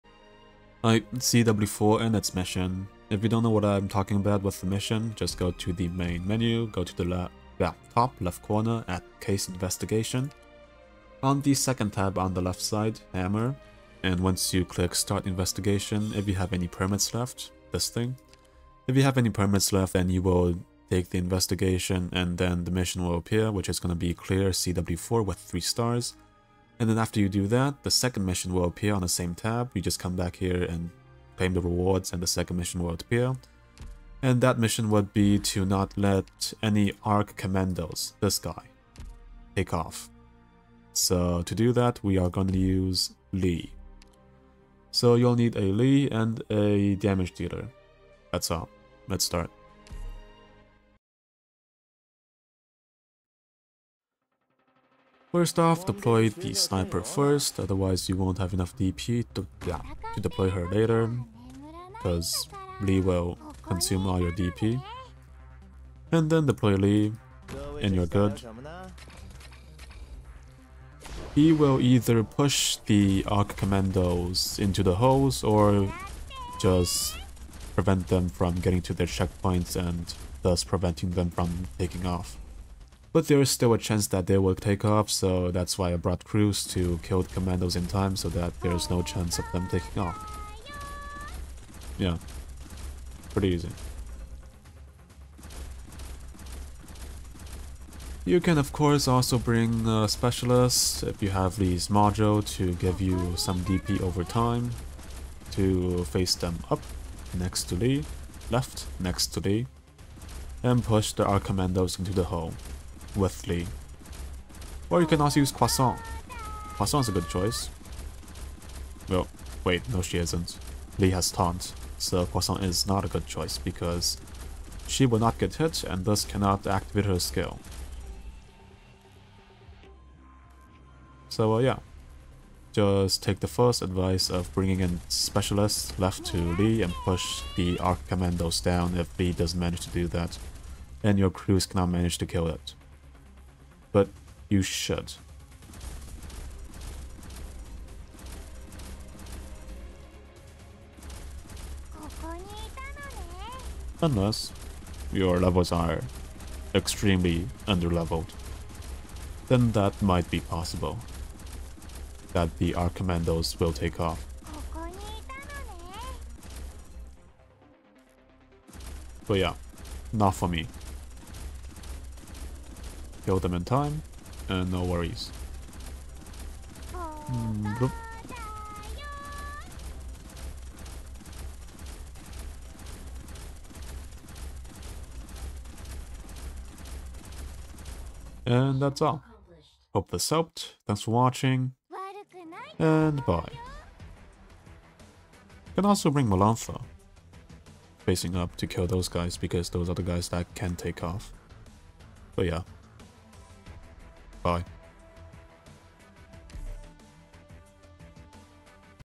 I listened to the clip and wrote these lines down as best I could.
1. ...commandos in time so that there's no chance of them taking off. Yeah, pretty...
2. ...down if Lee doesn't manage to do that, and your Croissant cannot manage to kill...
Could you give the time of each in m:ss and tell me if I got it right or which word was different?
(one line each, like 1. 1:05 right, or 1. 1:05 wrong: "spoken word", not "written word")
1. 1:27 right
2. 2:18 wrong: "Kroos", not "Croissant".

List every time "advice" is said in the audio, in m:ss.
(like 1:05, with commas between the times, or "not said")
2:13.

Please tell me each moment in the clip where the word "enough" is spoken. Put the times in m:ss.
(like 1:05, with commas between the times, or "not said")
0:58.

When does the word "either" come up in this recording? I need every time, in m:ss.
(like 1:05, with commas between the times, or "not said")
1:11.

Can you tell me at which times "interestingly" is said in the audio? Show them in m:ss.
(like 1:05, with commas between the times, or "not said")
not said.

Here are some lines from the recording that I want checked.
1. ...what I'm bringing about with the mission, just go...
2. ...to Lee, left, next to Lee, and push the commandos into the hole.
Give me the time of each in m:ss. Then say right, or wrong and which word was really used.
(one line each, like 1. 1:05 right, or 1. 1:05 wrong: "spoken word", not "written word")
1. 0:03 wrong: "talking", not "bringing"
2. 1:47 right.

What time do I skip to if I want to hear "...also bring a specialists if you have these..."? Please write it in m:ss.
1:39.